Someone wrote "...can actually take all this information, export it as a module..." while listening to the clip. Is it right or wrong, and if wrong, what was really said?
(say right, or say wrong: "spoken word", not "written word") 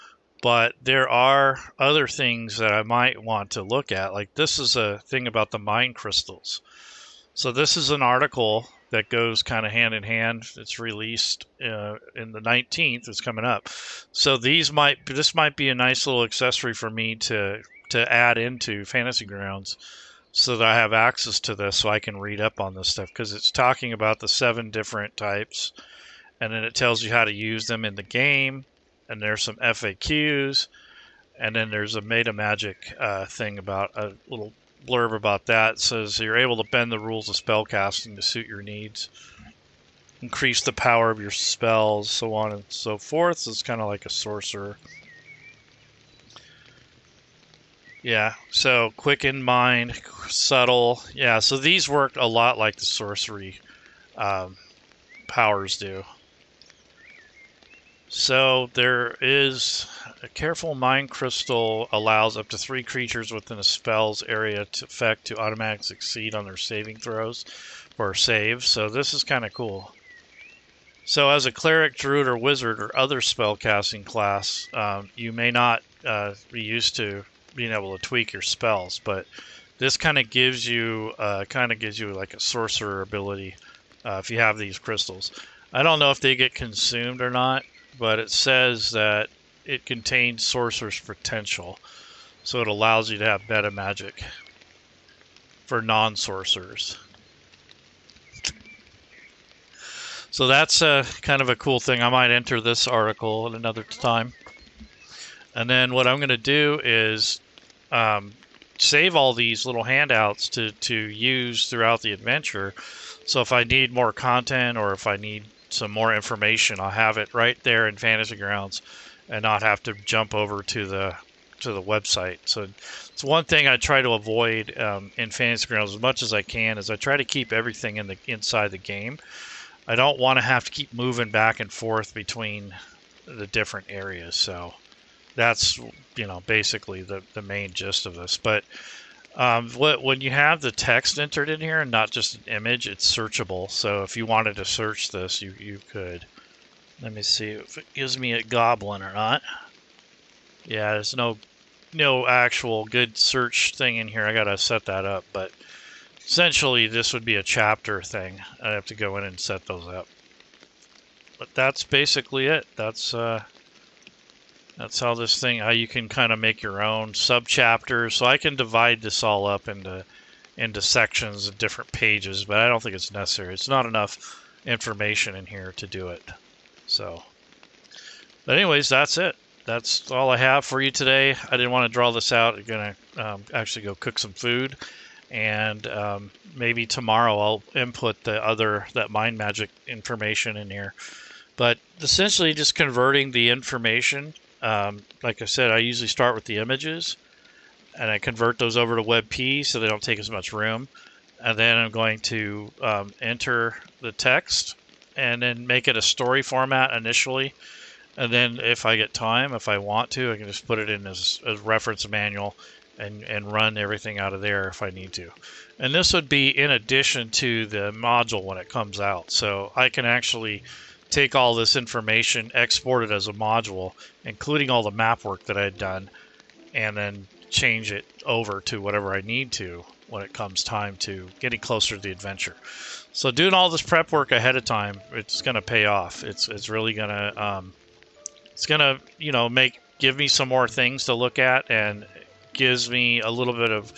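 right.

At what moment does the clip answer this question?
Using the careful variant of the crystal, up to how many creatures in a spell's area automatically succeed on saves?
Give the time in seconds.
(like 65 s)
62 s.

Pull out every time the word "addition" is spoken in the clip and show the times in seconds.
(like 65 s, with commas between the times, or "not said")
216 s.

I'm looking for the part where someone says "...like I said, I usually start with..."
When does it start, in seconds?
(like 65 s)
195 s.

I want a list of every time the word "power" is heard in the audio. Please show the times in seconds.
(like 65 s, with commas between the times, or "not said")
40 s, 55 s.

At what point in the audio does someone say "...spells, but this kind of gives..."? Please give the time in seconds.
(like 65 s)
78 s.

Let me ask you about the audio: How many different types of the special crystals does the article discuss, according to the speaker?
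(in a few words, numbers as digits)
7.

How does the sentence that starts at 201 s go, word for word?
And then I'm going to um, enter the text and then make it a story format initially.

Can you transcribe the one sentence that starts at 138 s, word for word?
But um, when you have the text entered in here and not just an image, it's searchable.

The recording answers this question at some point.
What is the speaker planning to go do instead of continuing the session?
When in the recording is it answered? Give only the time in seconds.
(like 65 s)
183 s.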